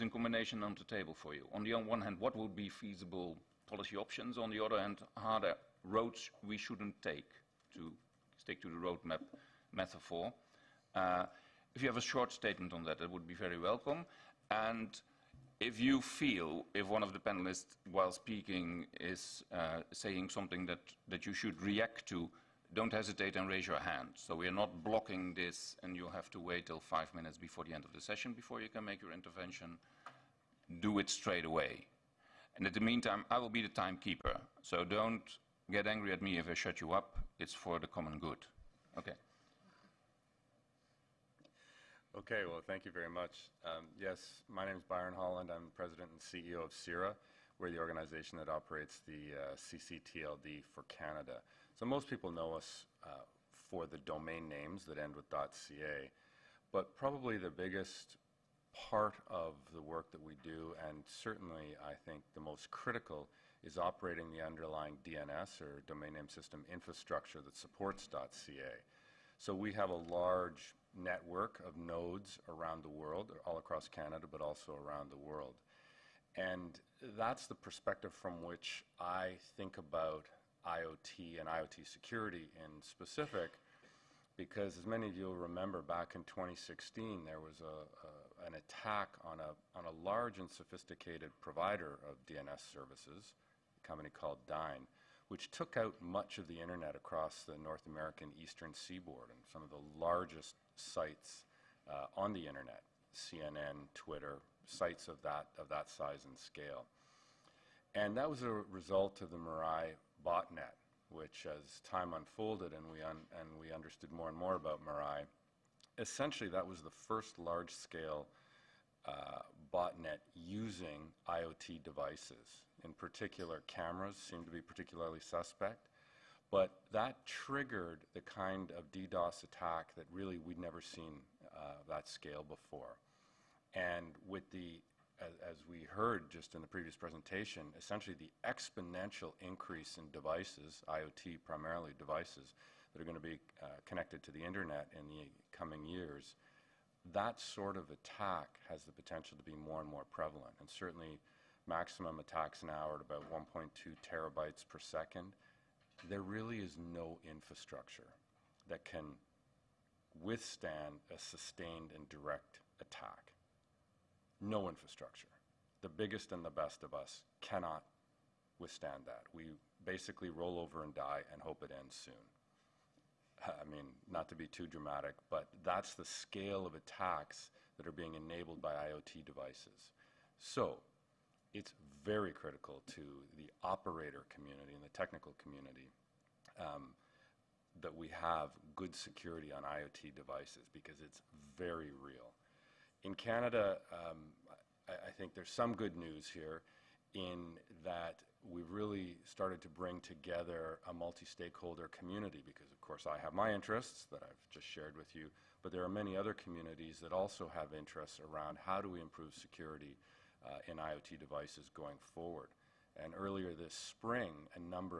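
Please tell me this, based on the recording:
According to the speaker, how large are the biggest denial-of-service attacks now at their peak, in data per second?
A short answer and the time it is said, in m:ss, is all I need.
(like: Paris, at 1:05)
1.2 terabytes per second, at 2:33.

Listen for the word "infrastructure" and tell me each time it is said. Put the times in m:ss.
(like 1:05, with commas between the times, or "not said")
1:06, 2:37, 2:44.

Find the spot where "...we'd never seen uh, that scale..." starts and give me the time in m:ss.
2:10.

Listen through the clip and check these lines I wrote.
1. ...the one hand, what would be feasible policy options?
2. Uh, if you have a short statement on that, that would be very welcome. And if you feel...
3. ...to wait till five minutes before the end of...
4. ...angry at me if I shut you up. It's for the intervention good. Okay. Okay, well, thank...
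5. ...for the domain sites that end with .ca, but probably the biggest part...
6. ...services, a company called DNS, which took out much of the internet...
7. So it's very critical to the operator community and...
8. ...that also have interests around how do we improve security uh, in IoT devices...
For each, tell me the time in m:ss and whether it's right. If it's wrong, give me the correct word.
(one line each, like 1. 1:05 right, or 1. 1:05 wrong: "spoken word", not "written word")
1. 0:01 right
2. 0:10 right
3. 0:26 right
4. 0:35 wrong: "common", not "intervention"
5. 0:53 wrong: "names", not "sites"
6. 1:32 wrong: "Dyn", not "DNS"
7. 3:00 right
8. 3:27 right.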